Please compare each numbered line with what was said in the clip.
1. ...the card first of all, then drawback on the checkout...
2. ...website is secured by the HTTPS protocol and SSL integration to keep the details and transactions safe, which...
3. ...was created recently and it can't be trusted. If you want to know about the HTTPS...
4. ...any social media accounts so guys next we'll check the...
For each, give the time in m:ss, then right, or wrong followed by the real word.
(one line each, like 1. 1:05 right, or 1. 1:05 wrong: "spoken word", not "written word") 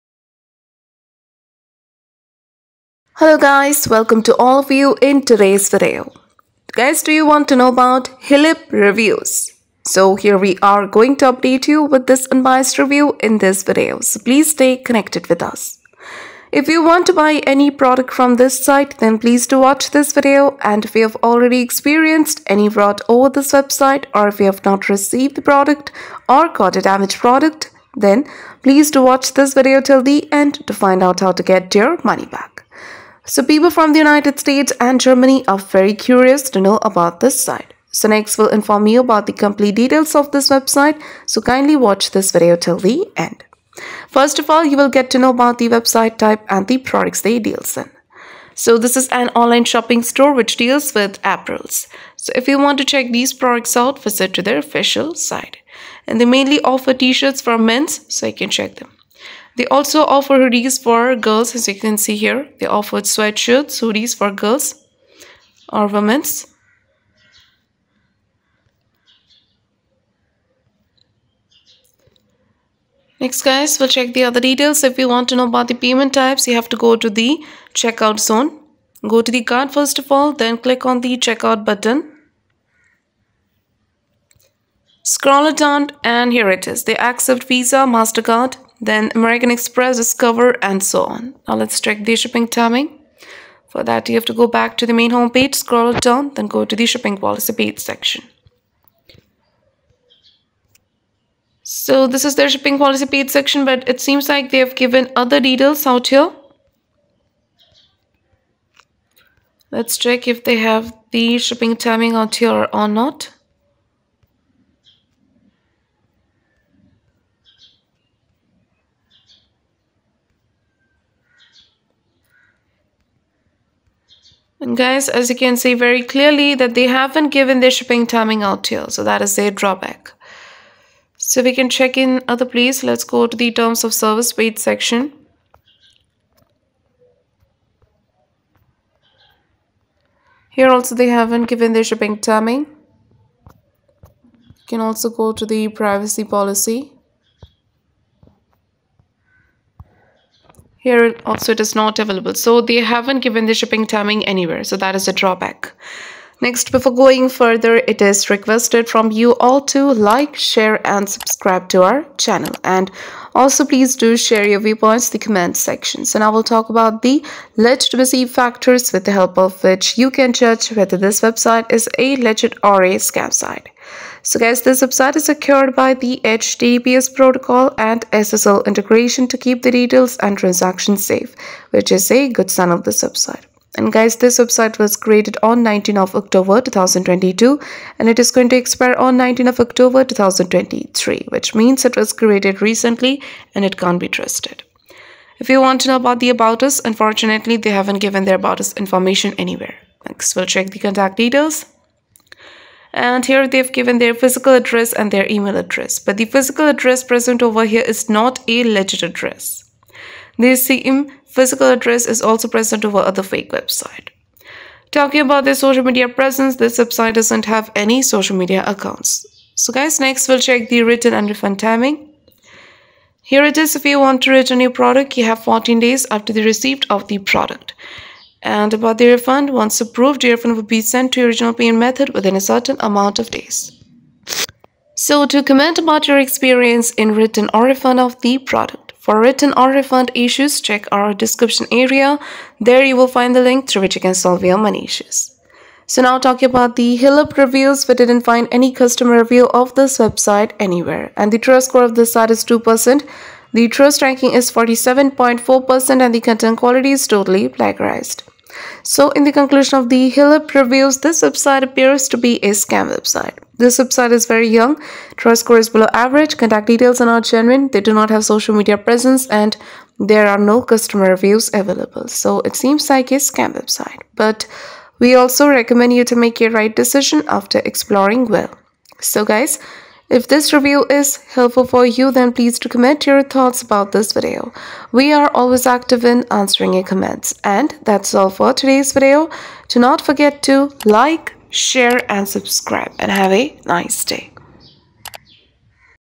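1. 1:19 wrong: "click", not "drawback"
2. 2:54 right
3. 3:11 wrong: "About", not "HTTPS"
4. 3:37 right.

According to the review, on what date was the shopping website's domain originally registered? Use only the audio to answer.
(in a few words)
19 October 2022.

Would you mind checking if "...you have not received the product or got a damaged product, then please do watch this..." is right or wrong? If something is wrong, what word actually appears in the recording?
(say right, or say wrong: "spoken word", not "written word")
right.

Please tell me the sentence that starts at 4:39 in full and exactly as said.
So, guys, if this review is helpful for you, then please to comment your thoughts about this video.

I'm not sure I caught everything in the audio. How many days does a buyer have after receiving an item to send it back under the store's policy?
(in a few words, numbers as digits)
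14 days.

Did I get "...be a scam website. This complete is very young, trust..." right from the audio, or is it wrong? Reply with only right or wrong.
wrong.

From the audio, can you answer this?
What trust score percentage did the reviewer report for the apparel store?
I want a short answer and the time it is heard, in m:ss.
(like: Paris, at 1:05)
2%, at 4:12.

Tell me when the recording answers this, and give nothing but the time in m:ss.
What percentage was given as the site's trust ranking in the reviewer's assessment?
4:14.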